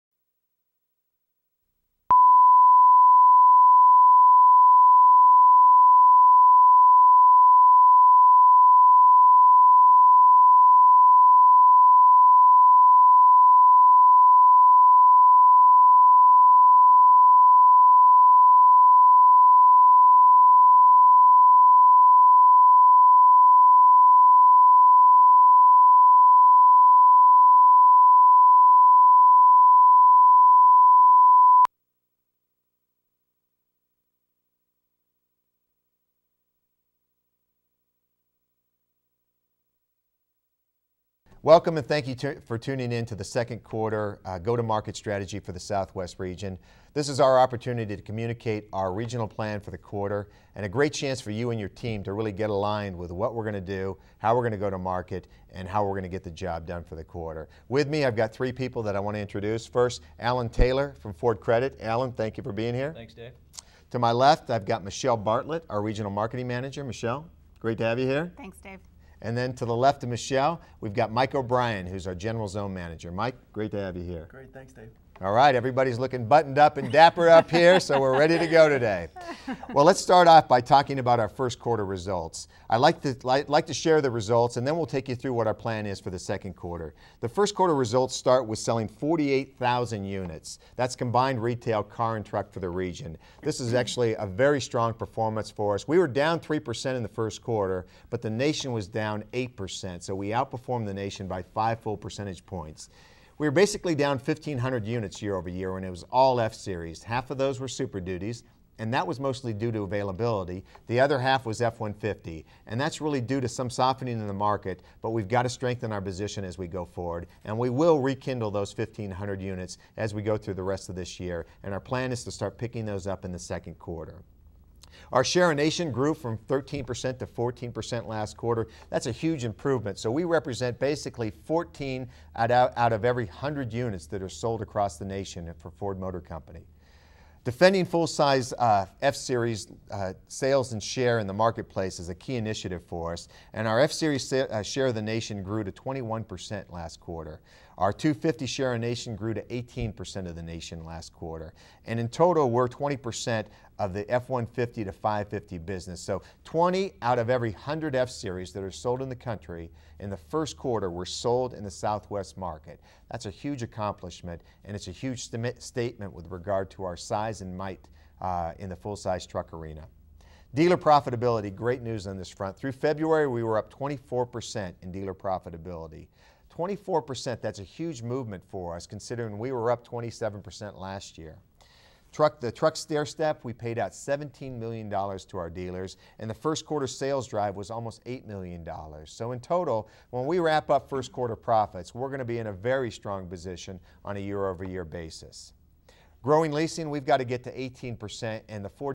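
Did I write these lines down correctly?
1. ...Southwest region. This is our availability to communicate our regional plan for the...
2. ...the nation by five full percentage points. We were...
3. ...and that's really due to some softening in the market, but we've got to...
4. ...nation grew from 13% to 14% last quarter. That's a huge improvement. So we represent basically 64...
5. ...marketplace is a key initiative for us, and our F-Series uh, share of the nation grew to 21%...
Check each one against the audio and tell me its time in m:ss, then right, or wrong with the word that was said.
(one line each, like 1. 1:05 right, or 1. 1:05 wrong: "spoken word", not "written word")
1. 0:45 wrong: "opportunity", not "availability"
2. 1:40 right
3. 1:52 right
4. 2:05 wrong: "14", not "64"
5. 2:21 right.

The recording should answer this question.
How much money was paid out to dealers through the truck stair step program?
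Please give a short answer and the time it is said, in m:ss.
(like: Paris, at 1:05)
$17 million, at 3:03.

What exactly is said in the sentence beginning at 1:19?
Well, let's start off by talking about our first quarter results.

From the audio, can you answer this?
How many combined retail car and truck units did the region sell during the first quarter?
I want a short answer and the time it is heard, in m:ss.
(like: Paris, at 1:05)
48,000, at 1:28.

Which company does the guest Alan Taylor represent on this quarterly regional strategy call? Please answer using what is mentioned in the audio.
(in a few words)
Ford Credit.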